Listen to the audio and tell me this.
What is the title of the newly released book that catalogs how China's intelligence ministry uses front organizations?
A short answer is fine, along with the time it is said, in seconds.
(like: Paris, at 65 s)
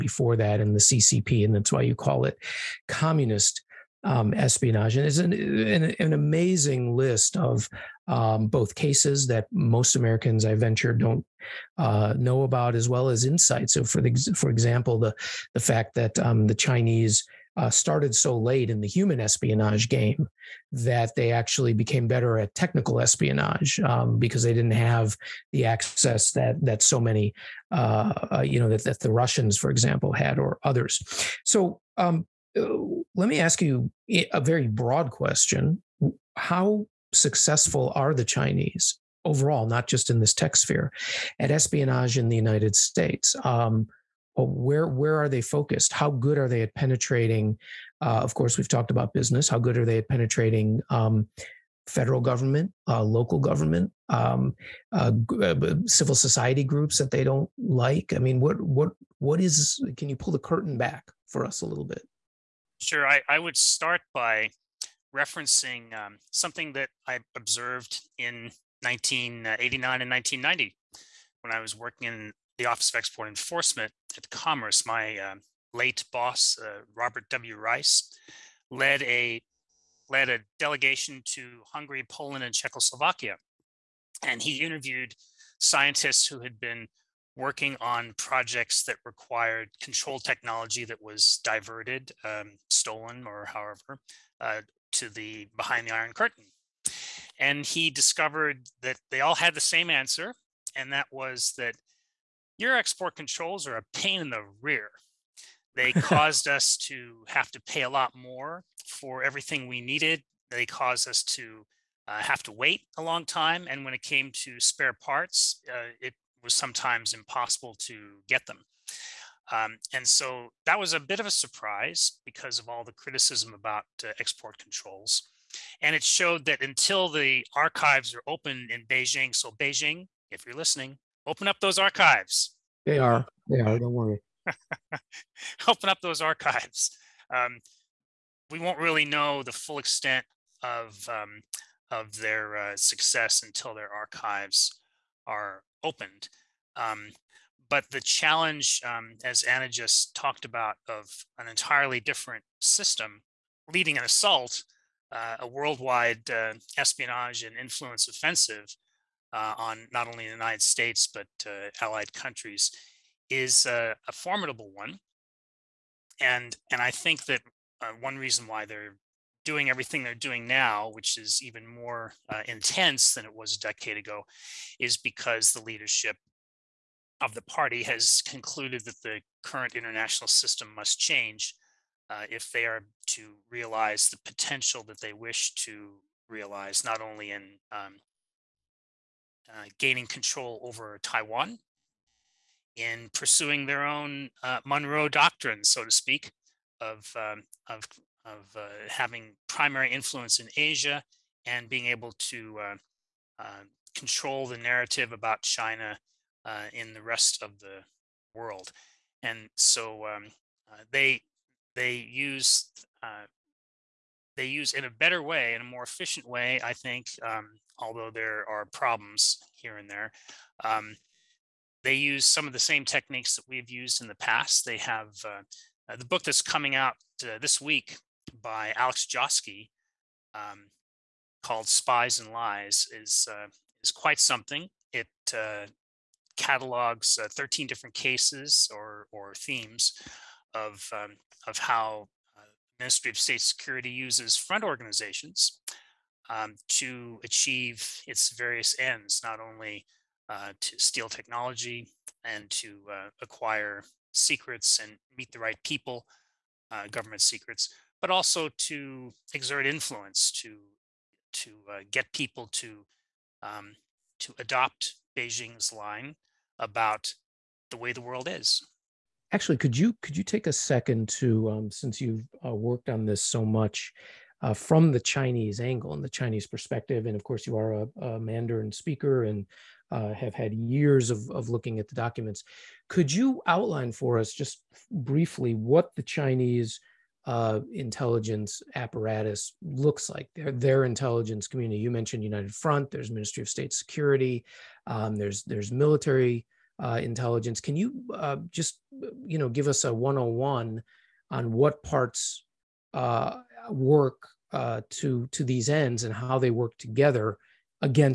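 Spies and Lies, at 231 s.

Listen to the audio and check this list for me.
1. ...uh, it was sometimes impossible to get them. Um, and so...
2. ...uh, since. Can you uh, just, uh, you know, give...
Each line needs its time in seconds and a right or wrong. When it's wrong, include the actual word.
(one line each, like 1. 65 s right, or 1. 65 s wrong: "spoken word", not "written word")
1. 115 s right
2. 296 s wrong: "intelligence", not "since".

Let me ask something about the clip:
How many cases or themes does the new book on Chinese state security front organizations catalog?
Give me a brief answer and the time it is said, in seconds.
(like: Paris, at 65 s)
13, at 237 s.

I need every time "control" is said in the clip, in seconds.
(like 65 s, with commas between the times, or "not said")
89 s, 103 s, 124 s, 190 s, 203 s.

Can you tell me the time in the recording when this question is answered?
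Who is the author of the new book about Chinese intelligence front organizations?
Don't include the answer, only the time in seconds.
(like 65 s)
228 s.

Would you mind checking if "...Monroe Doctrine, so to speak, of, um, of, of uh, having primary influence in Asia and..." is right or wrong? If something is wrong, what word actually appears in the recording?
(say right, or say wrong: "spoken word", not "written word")
right.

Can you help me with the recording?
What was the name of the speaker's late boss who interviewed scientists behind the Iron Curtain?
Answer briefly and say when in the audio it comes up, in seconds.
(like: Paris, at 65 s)
Robert W. Rice, at 76 s.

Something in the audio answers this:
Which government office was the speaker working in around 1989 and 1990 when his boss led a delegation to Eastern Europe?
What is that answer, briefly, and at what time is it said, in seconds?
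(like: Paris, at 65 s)
Office of Export Enforcement, at 72 s.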